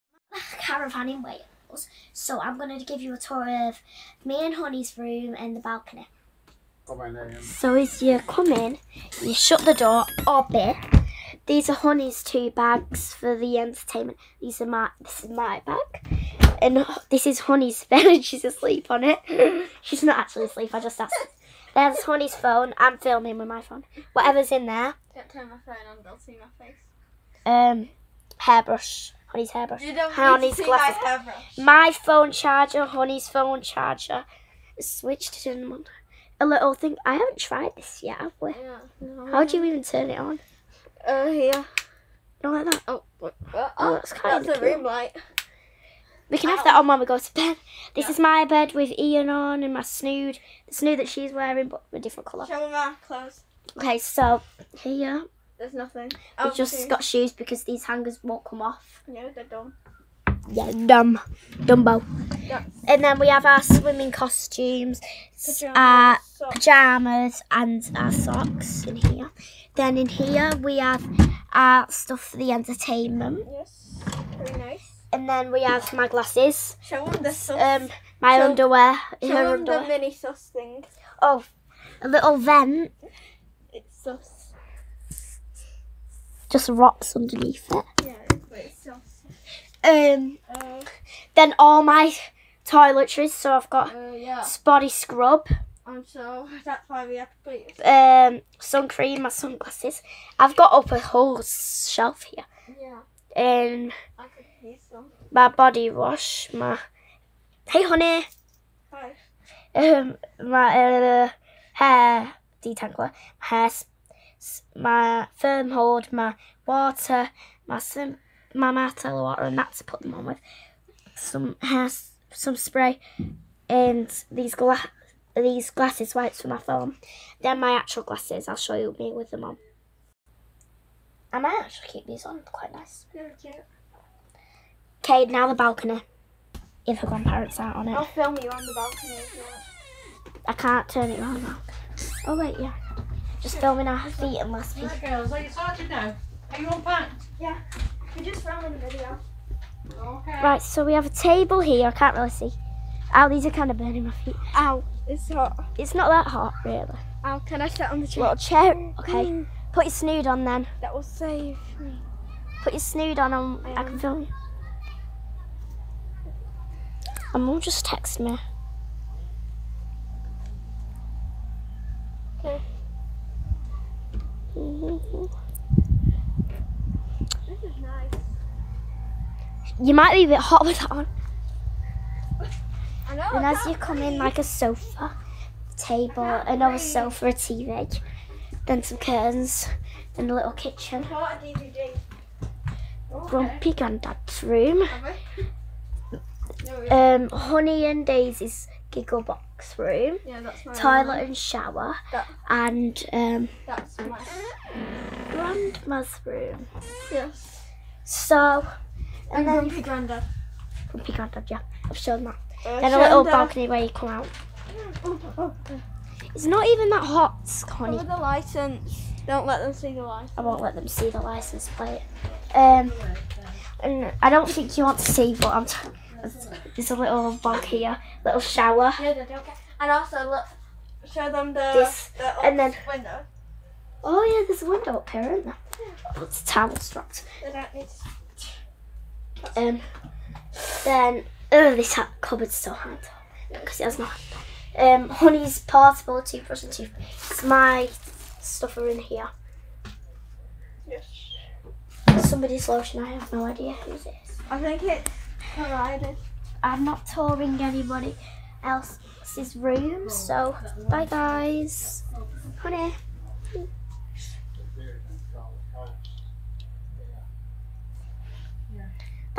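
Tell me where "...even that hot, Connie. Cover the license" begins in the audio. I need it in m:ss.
3:36.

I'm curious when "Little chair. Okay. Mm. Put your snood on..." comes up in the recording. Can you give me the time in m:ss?
2:38.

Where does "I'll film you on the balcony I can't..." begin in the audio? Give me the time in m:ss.
2:17.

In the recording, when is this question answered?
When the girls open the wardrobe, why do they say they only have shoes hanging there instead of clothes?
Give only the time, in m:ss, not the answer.
0:57.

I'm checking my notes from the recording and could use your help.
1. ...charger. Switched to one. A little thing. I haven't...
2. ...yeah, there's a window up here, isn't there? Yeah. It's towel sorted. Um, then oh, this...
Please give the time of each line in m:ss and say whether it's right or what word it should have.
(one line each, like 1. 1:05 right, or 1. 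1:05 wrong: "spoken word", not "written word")
1. 0:33 right
2. 3:54 wrong: "strapped", not "sorted".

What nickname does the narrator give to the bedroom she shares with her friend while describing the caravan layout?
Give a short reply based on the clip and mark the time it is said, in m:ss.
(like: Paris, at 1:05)
giggle box, at 3:18.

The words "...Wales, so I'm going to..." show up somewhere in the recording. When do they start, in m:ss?
0:01.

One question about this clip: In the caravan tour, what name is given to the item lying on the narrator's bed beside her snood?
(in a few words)
Ian.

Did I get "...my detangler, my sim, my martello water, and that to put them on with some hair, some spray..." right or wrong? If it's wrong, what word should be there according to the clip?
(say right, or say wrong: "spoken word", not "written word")
wrong: "water", not "detangler".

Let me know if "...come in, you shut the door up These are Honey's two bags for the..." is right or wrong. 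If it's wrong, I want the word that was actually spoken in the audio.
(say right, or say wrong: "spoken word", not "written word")
right.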